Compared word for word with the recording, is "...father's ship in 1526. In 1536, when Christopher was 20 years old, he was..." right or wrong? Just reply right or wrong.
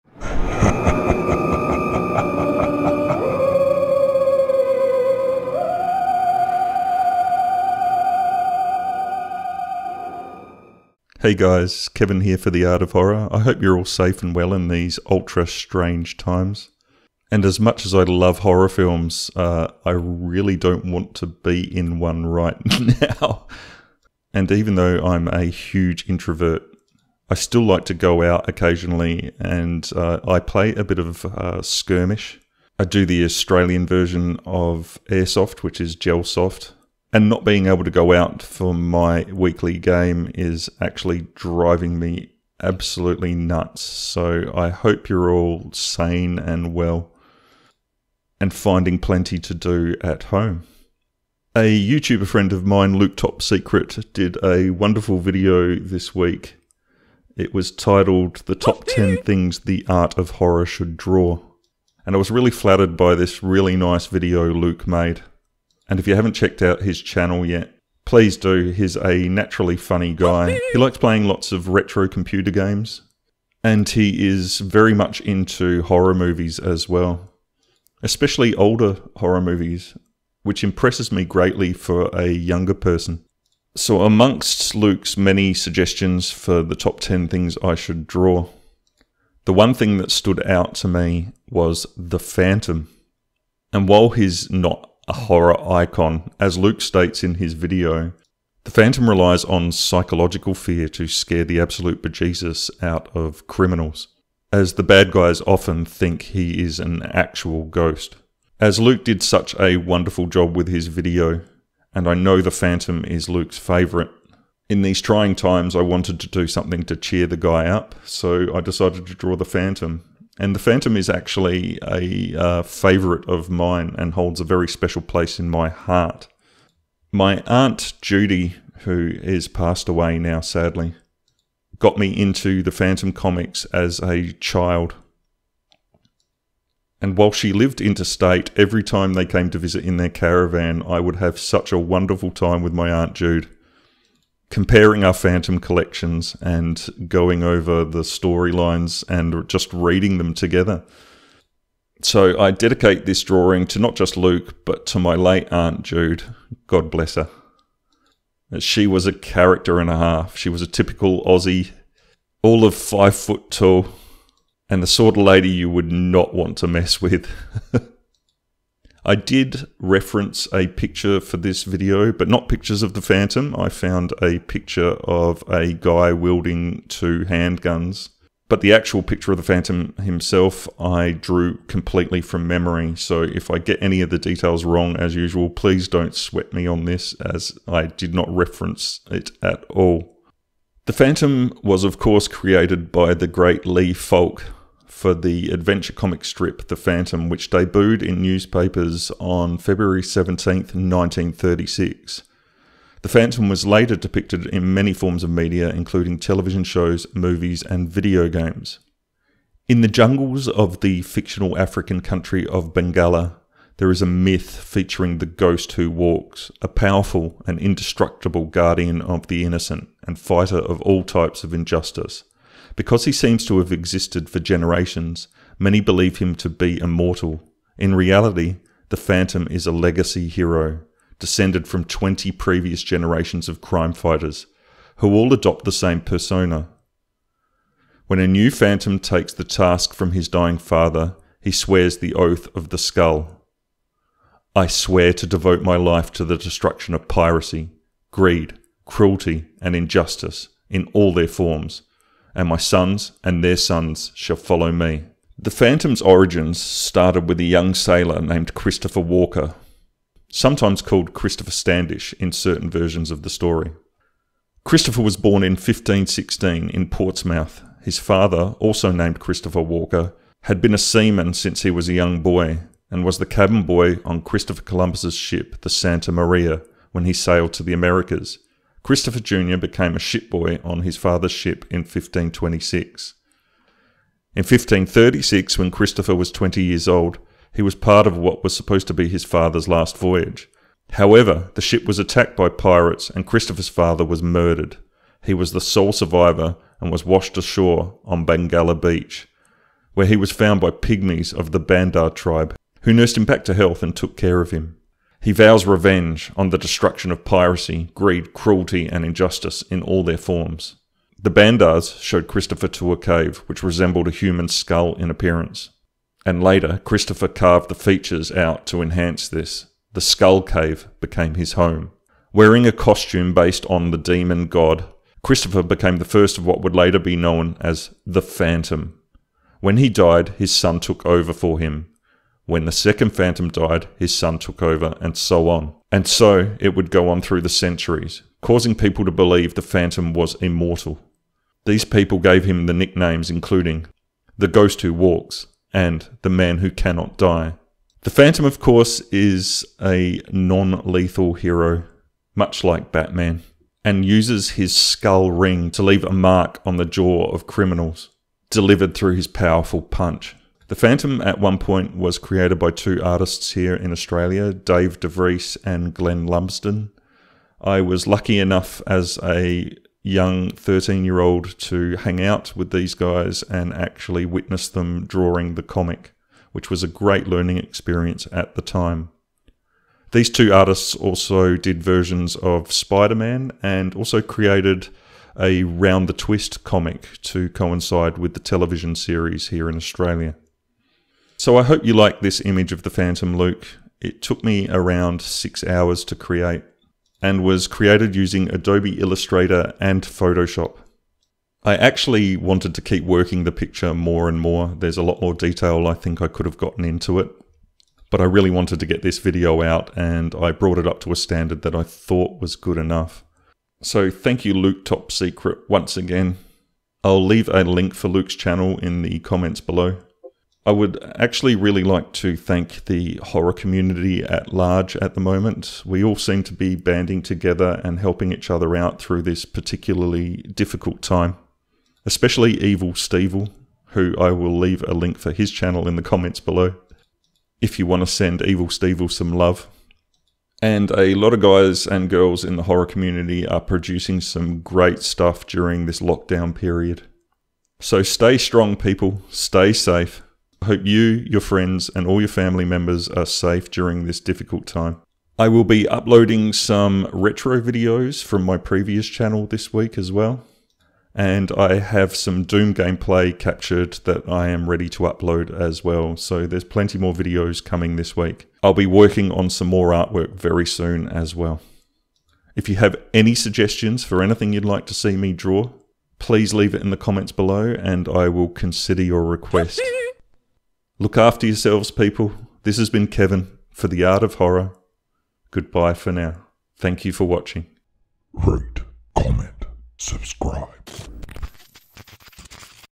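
right.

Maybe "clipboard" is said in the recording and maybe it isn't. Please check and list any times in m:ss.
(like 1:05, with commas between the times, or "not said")
not said.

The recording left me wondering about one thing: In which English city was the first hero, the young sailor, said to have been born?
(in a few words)
Portsmouth.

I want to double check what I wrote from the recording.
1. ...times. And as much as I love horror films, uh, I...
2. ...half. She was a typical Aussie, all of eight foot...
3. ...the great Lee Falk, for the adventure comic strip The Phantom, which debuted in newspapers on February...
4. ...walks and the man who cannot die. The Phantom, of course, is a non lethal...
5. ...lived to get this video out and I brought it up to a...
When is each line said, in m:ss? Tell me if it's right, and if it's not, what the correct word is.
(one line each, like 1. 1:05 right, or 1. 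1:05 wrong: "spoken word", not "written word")
1. 0:16 right
2. 2:39 wrong: "five", not "eight"
3. 3:13 right
4. 5:44 right
5. 6:48 wrong: "wanted", not "lived".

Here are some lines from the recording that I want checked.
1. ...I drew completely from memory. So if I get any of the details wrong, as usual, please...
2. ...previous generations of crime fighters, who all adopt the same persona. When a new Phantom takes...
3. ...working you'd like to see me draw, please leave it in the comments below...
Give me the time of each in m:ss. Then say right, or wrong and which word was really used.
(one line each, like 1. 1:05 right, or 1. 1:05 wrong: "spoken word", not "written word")
1. 3:00 right
2. 3:52 right
3. 7:54 wrong: "anything", not "working".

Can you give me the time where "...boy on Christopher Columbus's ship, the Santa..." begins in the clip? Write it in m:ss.
4:33.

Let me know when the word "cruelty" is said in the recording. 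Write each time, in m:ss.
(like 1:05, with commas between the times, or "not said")
4:08, 5:08.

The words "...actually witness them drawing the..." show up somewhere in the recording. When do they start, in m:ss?
6:13.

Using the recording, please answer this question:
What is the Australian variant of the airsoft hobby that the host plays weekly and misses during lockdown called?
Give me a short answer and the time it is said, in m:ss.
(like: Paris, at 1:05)
Gelsoft, at 0:35.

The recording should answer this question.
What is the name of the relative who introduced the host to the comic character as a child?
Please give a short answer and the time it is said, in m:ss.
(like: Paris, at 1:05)
Judy, at 2:08.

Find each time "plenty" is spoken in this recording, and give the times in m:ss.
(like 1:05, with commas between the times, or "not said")
0:48, 7:46.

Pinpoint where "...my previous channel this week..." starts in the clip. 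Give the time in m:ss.
7:38.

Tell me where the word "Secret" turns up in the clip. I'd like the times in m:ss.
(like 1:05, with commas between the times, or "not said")
0:53, 6:55.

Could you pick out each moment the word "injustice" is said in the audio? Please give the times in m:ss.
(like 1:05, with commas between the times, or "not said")
3:41, 4:09, 5:09.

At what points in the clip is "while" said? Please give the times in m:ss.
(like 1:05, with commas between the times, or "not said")
1:33, 2:17.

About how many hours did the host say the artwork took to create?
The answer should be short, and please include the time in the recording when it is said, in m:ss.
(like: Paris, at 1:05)
6, at 6:35.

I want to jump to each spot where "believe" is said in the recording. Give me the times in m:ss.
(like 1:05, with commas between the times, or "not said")
3:45, 5:39.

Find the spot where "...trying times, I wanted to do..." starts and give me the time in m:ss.
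1:55.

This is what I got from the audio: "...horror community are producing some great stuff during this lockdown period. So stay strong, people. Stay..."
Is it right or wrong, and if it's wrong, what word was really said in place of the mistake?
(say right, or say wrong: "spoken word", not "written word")
right.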